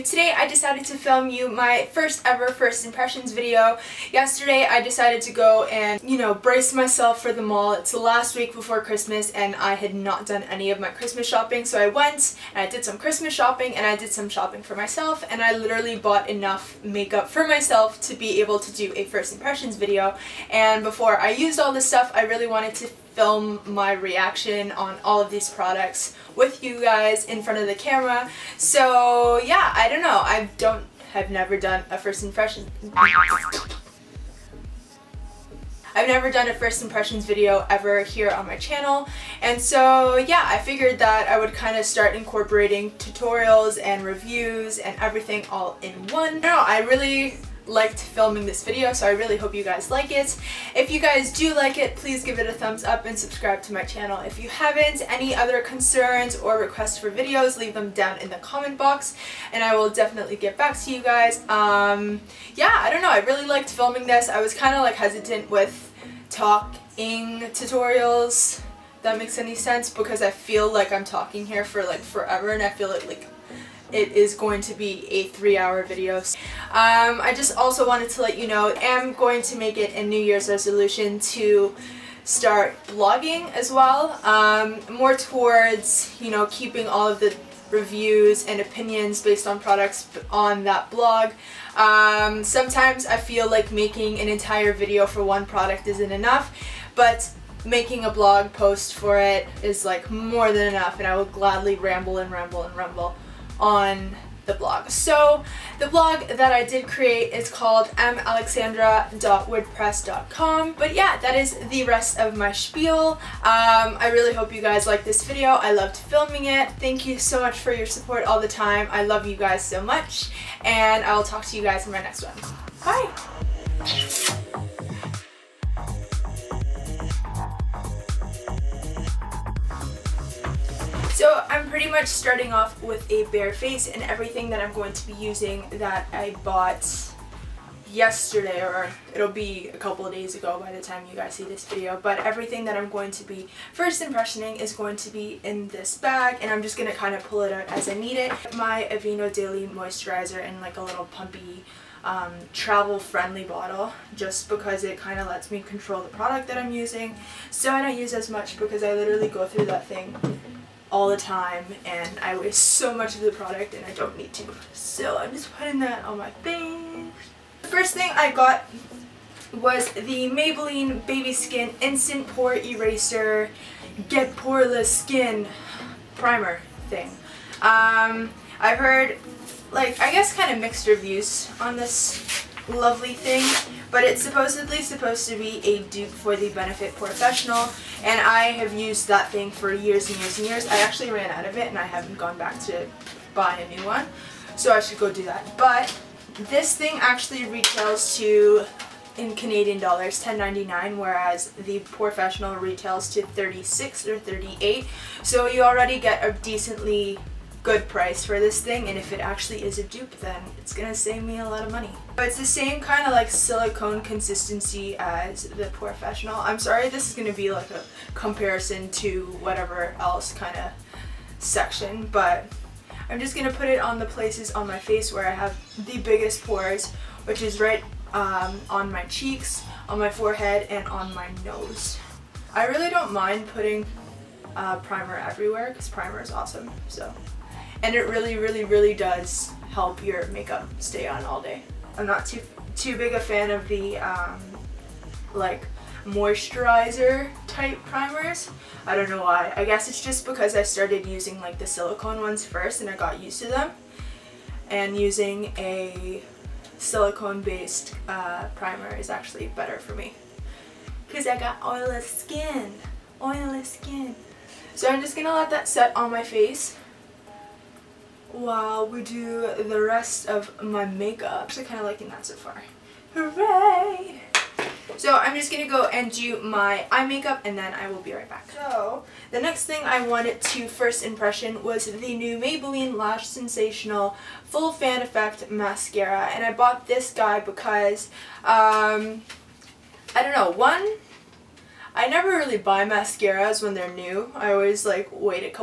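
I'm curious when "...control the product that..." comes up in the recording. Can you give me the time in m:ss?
2:35.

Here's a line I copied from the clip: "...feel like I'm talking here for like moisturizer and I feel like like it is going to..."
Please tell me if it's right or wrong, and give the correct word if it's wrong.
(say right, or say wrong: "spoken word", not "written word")
wrong: "forever", not "moisturizer".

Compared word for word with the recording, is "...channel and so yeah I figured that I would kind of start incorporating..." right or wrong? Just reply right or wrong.
right.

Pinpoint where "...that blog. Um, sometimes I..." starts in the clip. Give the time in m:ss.
1:30.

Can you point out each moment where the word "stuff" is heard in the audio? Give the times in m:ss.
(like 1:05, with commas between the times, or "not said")
0:21.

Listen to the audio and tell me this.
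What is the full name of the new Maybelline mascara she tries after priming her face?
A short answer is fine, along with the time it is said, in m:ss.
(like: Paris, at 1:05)
Lash Sensational Full Fan Effect, at 4:42.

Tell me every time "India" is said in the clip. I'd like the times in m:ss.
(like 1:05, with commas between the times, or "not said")
not said.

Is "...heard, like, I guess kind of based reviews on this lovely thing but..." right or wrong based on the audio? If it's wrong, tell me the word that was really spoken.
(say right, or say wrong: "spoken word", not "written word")
wrong: "mixed", not "based".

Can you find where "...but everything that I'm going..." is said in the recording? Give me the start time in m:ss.
2:22.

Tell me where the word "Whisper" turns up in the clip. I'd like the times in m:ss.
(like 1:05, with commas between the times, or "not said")
not said.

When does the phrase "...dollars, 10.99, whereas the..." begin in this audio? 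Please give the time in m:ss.
3:19.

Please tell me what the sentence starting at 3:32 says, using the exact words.
But it's the same kind of like silicone consistency as the POREfessional.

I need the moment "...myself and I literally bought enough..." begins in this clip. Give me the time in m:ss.
0:14.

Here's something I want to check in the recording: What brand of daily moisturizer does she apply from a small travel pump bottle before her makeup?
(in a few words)
Aveeno.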